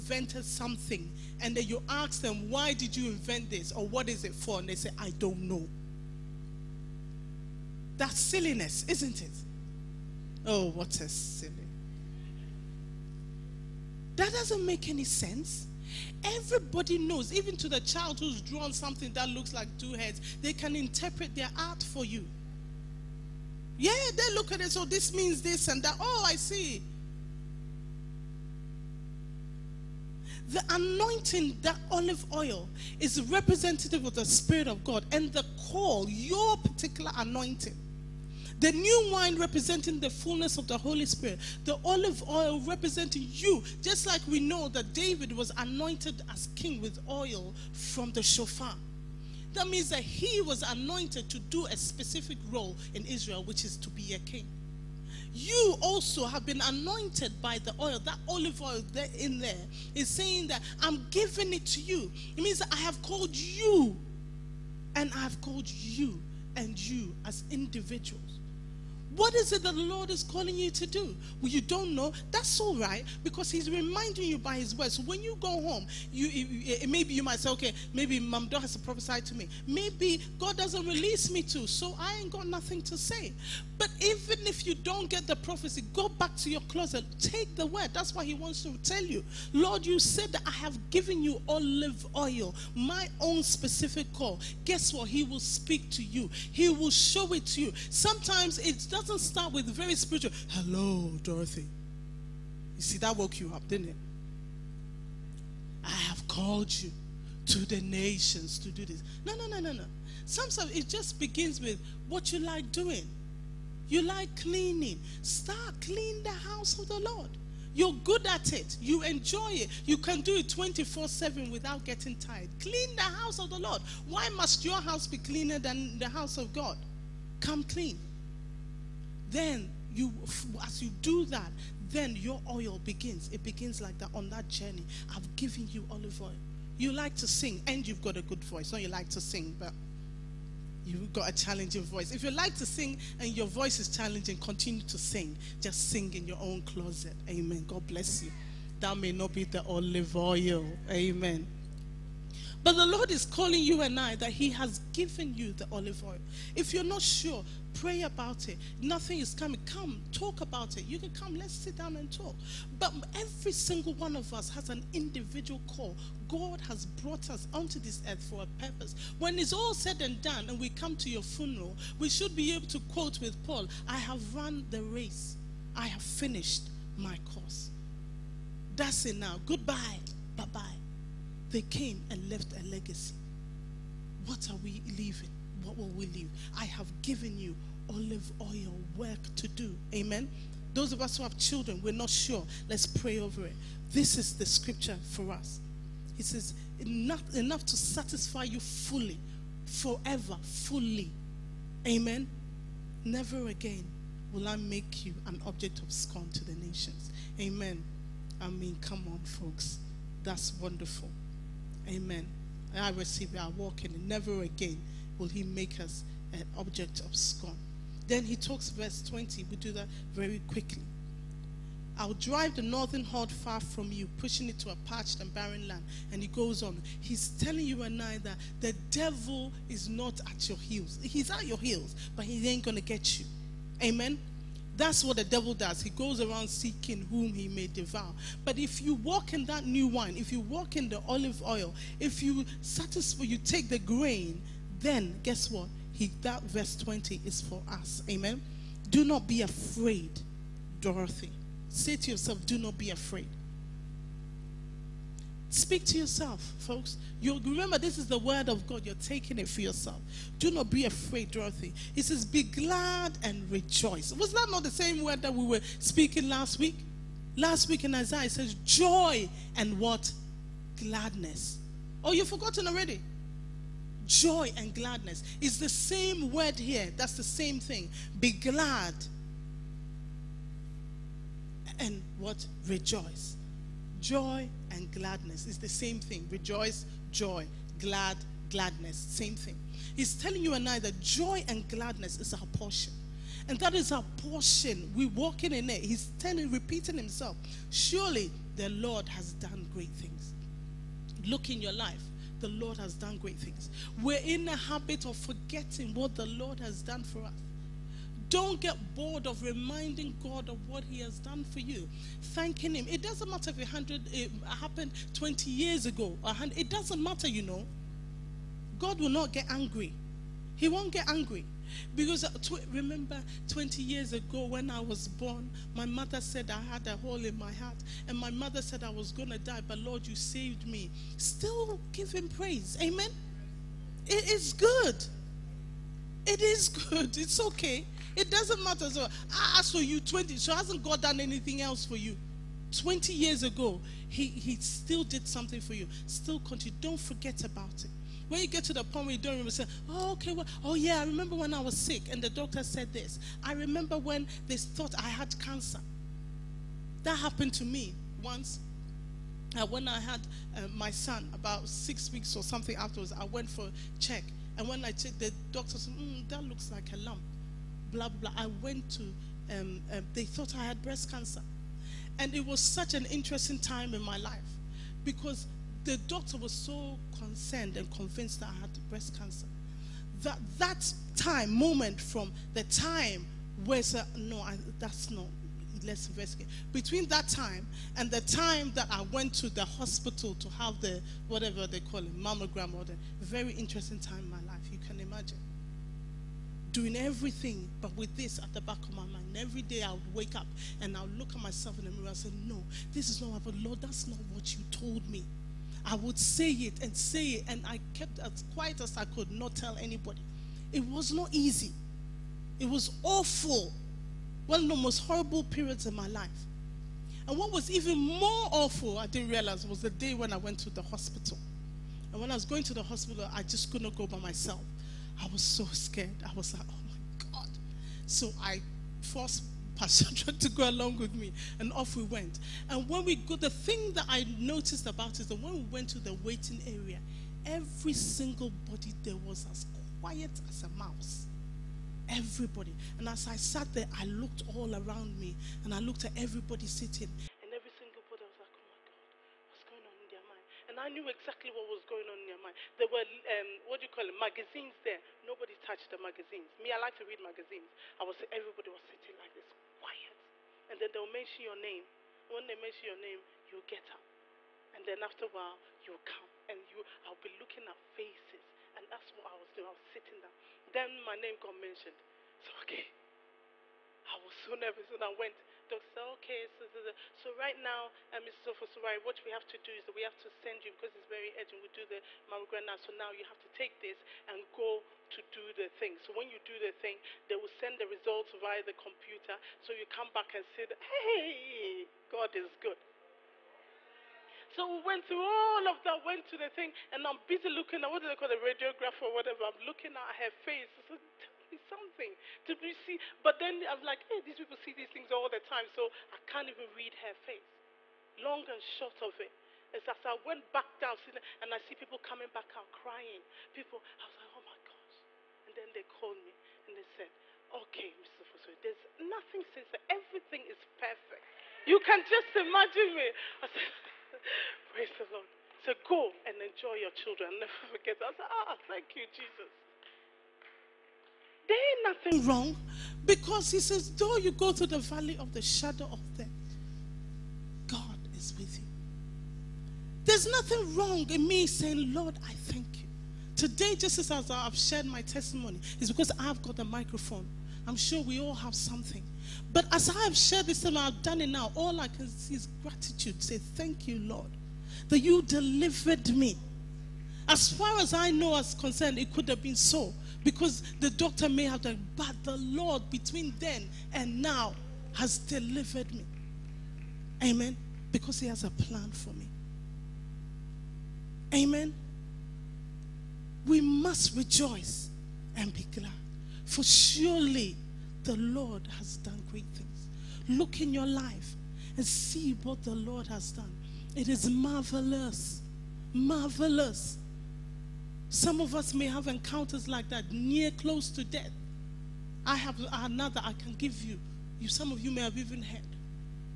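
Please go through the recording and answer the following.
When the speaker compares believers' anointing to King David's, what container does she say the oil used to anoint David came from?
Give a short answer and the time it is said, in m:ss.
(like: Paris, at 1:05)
shofar, at 0:48.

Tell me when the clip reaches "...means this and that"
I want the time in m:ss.
0:25.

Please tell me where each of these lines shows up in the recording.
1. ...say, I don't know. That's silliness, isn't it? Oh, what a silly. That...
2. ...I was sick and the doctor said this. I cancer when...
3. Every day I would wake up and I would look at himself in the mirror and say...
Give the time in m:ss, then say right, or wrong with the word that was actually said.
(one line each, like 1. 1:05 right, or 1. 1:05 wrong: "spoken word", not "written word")
1. 0:04 right
2. 5:51 wrong: "remember", not "cancer"
3. 6:39 wrong: "myself", not "himself".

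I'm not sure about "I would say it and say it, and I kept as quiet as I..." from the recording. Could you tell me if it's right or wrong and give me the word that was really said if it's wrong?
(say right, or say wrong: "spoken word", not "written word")
right.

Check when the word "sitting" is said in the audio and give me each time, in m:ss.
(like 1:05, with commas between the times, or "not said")
7:26, 7:38, 7:49.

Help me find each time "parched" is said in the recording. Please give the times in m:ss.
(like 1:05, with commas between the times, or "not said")
3:44.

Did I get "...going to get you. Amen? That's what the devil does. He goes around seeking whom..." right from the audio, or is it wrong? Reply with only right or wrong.
right.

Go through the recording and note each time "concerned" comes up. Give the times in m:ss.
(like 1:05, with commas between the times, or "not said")
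6:17, 9:18.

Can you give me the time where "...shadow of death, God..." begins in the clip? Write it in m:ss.
8:55.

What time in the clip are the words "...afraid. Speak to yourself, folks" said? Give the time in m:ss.
4:12.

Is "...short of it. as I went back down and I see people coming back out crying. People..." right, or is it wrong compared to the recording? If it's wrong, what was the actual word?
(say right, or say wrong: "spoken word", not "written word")
right.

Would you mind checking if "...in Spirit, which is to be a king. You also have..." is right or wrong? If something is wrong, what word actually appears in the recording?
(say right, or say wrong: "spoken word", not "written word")
wrong: "Israel", not "Spirit".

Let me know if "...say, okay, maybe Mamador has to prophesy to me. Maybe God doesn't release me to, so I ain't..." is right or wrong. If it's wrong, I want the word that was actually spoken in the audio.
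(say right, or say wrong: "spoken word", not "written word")
right.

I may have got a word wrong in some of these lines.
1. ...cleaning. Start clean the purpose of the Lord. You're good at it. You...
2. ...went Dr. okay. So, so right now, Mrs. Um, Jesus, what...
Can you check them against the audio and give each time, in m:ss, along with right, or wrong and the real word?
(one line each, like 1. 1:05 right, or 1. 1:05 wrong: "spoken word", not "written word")
1. 1:54 wrong: "house", not "purpose"
2. 7:55 wrong: "Ofosuware", not "Jesus".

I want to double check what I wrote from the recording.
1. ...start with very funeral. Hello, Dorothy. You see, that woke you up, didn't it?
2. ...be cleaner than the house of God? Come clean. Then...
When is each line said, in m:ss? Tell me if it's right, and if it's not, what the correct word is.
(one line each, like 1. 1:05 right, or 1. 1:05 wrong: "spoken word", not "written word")
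1. 1:39 wrong: "spiritual", not "funeral"
2. 2:05 right.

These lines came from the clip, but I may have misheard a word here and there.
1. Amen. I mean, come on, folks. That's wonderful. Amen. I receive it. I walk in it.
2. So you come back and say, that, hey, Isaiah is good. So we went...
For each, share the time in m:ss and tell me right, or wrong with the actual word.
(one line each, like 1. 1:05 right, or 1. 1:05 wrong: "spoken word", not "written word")
1. 3:27 right
2. 8:09 wrong: "God", not "Isaiah".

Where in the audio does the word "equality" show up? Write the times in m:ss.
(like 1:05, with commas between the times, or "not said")
not said.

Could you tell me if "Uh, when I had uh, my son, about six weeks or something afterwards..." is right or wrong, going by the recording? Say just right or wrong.
right.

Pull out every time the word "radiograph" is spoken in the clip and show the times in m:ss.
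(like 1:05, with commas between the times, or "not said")
8:18.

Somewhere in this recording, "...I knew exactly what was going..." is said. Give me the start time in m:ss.
7:30.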